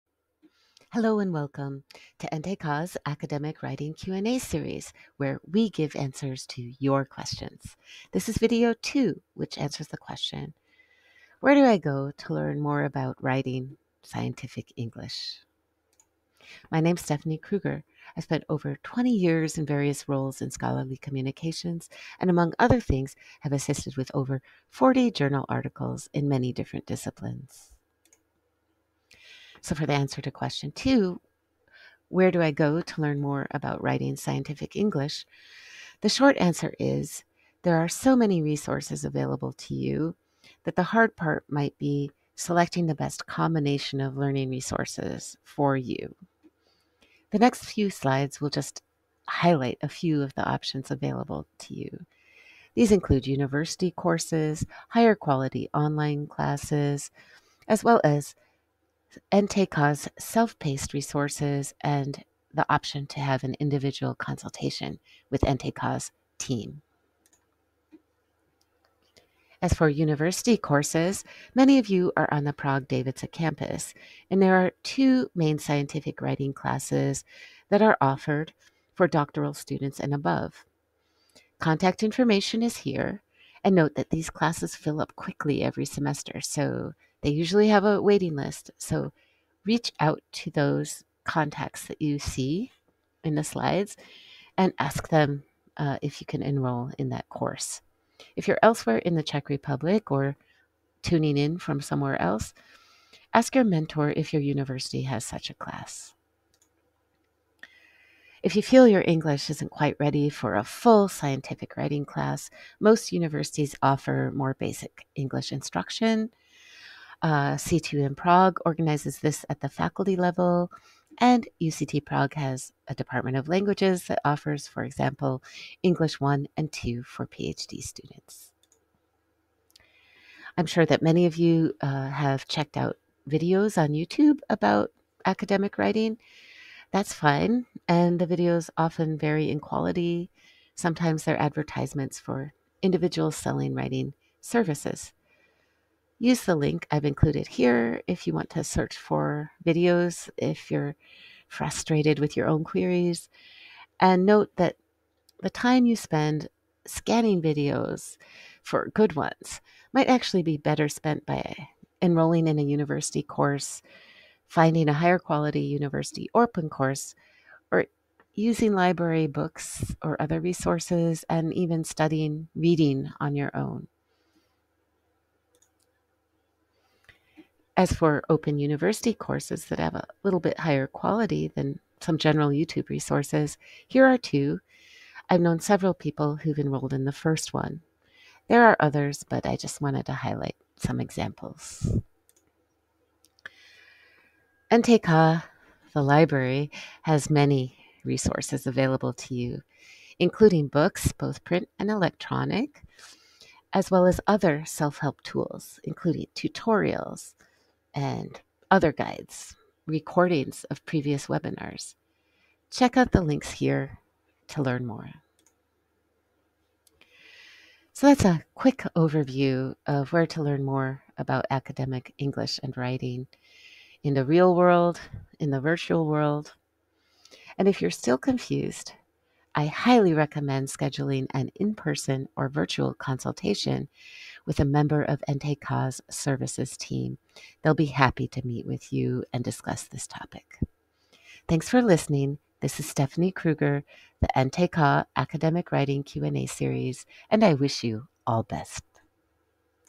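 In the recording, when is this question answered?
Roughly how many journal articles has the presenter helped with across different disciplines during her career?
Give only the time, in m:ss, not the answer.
0:24.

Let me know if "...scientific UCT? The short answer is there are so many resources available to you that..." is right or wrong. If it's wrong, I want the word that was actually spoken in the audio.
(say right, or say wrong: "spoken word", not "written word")
wrong: "English", not "UCT".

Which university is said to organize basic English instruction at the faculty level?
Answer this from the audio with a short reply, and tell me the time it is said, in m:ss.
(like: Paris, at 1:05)
CTU in Prague, at 1:57.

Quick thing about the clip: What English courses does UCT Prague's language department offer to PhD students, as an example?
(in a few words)
English 1 and 2.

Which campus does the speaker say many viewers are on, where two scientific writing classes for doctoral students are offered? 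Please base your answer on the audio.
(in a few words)
Prague Dejvice.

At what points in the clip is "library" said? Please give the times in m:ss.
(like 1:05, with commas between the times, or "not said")
2:48, 3:16.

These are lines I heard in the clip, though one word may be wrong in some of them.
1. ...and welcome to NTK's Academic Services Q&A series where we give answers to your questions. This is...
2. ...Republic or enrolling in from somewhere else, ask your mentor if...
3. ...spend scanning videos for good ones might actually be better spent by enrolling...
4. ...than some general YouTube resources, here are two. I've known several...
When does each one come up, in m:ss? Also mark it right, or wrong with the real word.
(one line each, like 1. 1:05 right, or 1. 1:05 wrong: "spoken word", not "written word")
1. 0:01 wrong: "Writing", not "Services"
2. 1:39 wrong: "tuning", not "enrolling"
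3. 2:35 right
4. 3:01 right.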